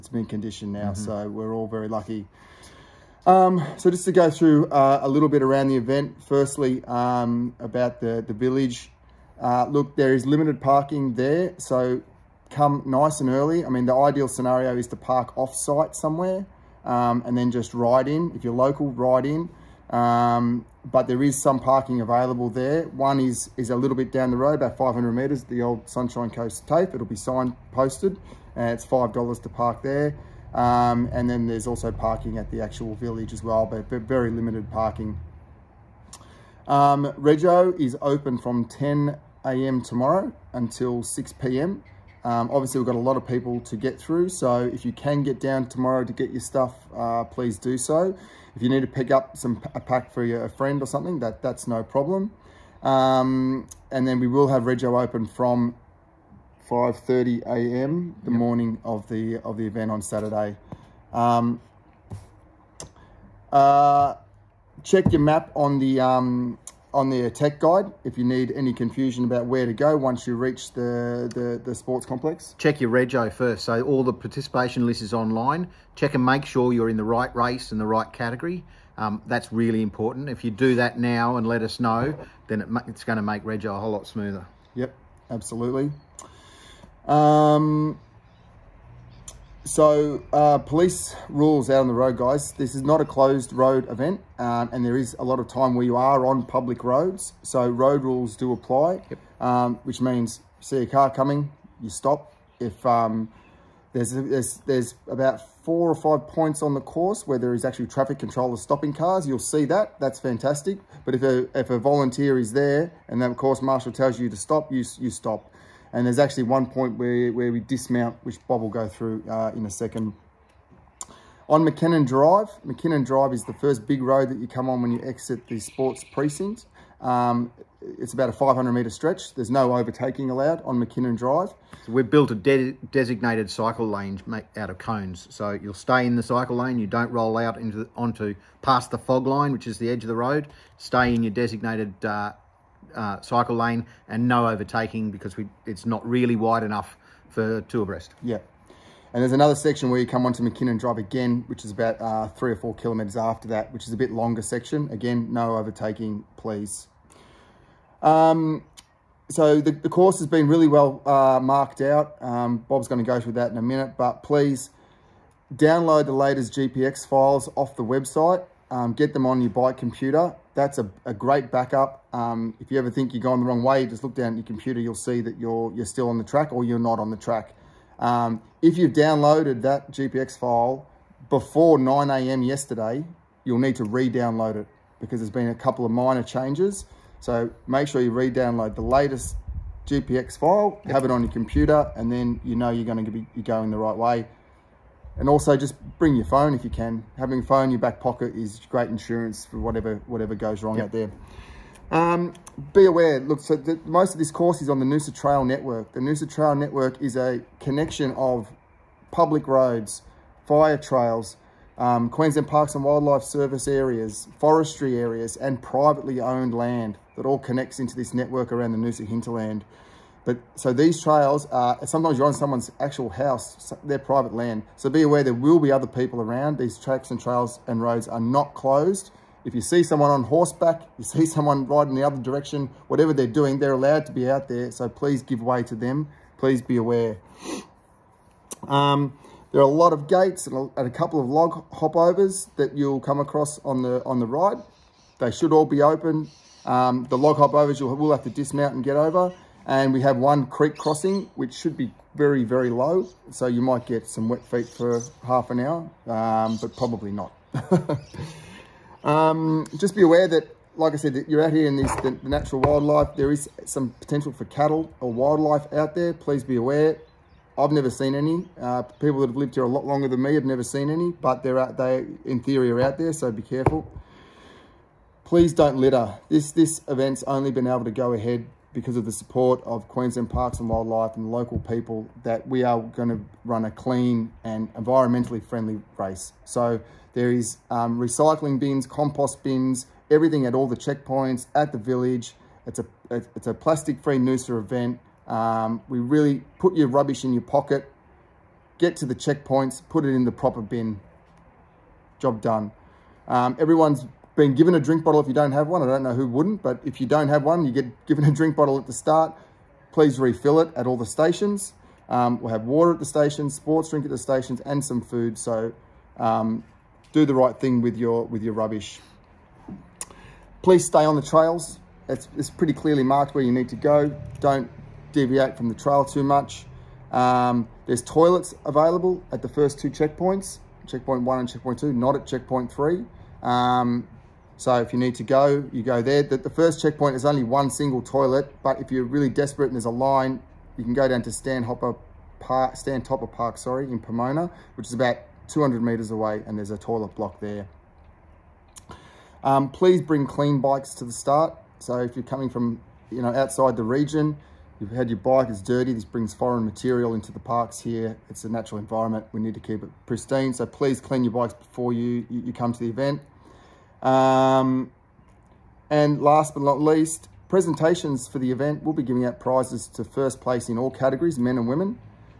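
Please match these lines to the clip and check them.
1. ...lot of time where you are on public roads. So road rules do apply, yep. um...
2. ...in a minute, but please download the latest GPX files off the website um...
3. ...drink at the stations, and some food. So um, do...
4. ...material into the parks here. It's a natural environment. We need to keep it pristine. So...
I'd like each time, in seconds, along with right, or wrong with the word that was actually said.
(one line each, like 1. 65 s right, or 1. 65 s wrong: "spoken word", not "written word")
1. 95 s right
2. 163 s right
3. 313 s right
4. 356 s right.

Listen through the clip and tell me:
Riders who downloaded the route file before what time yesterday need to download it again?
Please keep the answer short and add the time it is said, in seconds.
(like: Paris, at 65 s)
9 a.m., at 181 s.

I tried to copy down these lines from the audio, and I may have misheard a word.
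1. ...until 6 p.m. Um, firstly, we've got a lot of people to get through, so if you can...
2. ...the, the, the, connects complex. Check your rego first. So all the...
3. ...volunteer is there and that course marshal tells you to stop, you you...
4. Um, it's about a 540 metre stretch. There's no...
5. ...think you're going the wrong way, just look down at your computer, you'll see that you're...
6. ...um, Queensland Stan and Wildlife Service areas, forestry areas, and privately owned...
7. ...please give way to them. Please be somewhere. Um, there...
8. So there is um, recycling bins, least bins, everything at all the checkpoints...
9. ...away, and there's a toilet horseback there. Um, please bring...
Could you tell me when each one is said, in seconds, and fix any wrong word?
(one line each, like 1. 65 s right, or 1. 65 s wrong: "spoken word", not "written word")
1. 40 s wrong: "obviously", not "firstly"
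2. 70 s wrong: "sports", not "connects"
3. 111 s right
4. 127 s wrong: "500", not "540"
5. 172 s right
6. 211 s wrong: "Parks", not "Stan"
7. 234 s wrong: "aware", not "somewhere"
8. 286 s wrong: "compost", not "least"
9. 346 s wrong: "block", not "horseback".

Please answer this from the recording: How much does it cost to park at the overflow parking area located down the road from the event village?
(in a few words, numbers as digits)
$5.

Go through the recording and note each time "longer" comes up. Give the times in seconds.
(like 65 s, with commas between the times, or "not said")
154 s, 269 s.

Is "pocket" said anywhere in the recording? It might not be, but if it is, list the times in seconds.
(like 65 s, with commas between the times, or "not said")
197 s, 297 s.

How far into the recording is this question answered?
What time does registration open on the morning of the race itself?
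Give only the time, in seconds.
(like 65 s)
56 s.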